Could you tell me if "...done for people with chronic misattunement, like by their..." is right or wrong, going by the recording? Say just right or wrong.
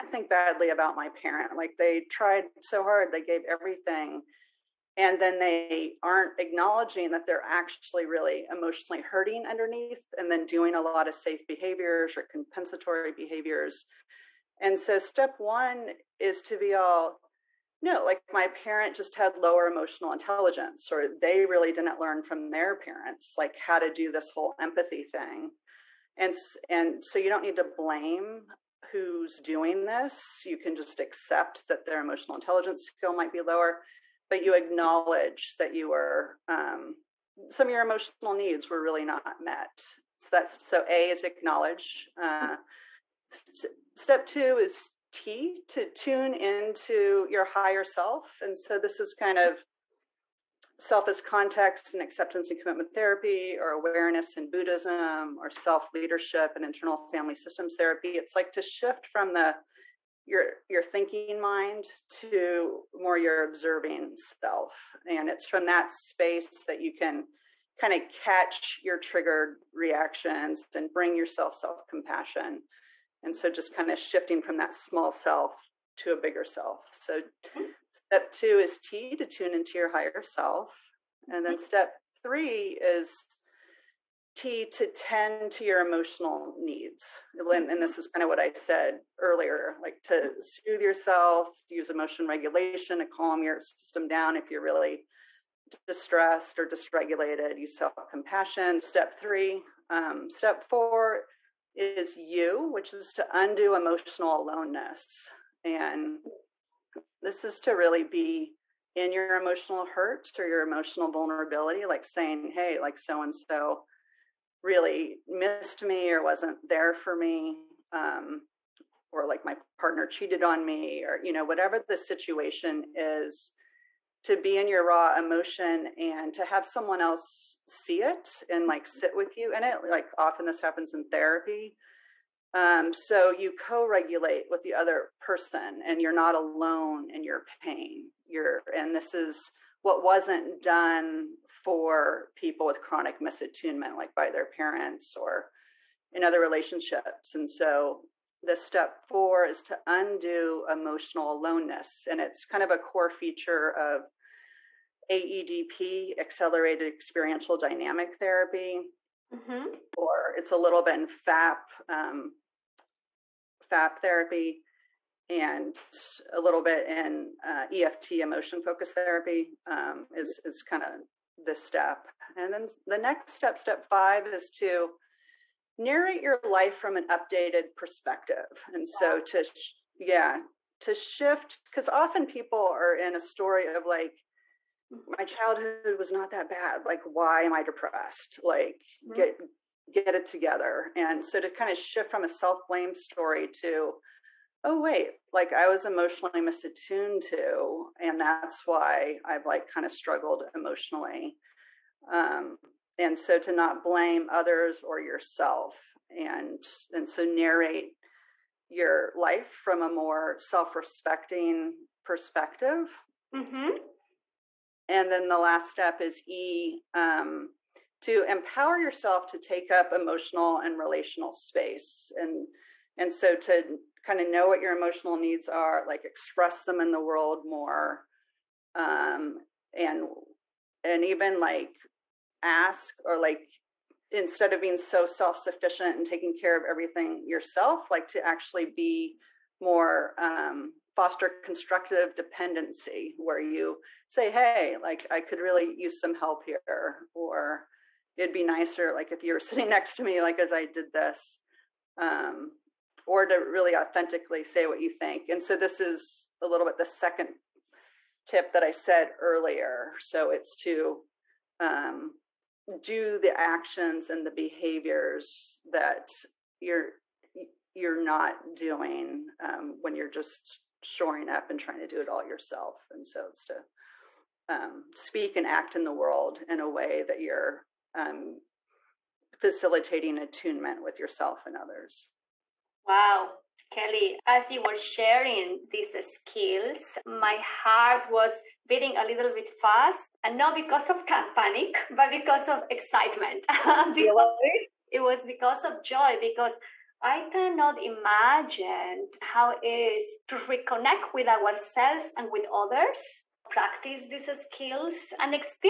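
right.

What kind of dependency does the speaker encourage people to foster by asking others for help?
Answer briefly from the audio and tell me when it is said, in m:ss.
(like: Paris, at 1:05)
Constructive dependency, at 4:01.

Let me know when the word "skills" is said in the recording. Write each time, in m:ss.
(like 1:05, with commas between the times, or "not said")
0:32, 4:46, 5:04.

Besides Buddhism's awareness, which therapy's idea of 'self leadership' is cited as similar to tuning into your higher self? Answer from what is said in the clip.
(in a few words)
Internal family systems therapy.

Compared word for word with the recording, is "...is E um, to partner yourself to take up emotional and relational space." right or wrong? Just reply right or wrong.
wrong.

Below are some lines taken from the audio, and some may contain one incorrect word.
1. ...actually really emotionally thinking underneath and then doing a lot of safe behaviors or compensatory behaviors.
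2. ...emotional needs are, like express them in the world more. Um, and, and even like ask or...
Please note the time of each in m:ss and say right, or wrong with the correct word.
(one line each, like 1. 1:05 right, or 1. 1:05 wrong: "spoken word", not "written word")
1. 0:07 wrong: "hurting", not "thinking"
2. 3:44 right.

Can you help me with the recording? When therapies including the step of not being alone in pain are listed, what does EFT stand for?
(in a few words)
Emotion focused therapy.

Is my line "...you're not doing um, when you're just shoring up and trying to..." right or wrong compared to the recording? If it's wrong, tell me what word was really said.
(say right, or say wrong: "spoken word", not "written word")
right.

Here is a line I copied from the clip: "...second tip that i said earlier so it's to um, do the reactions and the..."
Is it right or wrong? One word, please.
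wrong.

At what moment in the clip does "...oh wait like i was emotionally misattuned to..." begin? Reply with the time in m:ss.
3:14.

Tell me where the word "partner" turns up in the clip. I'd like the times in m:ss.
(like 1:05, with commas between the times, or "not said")
1:59.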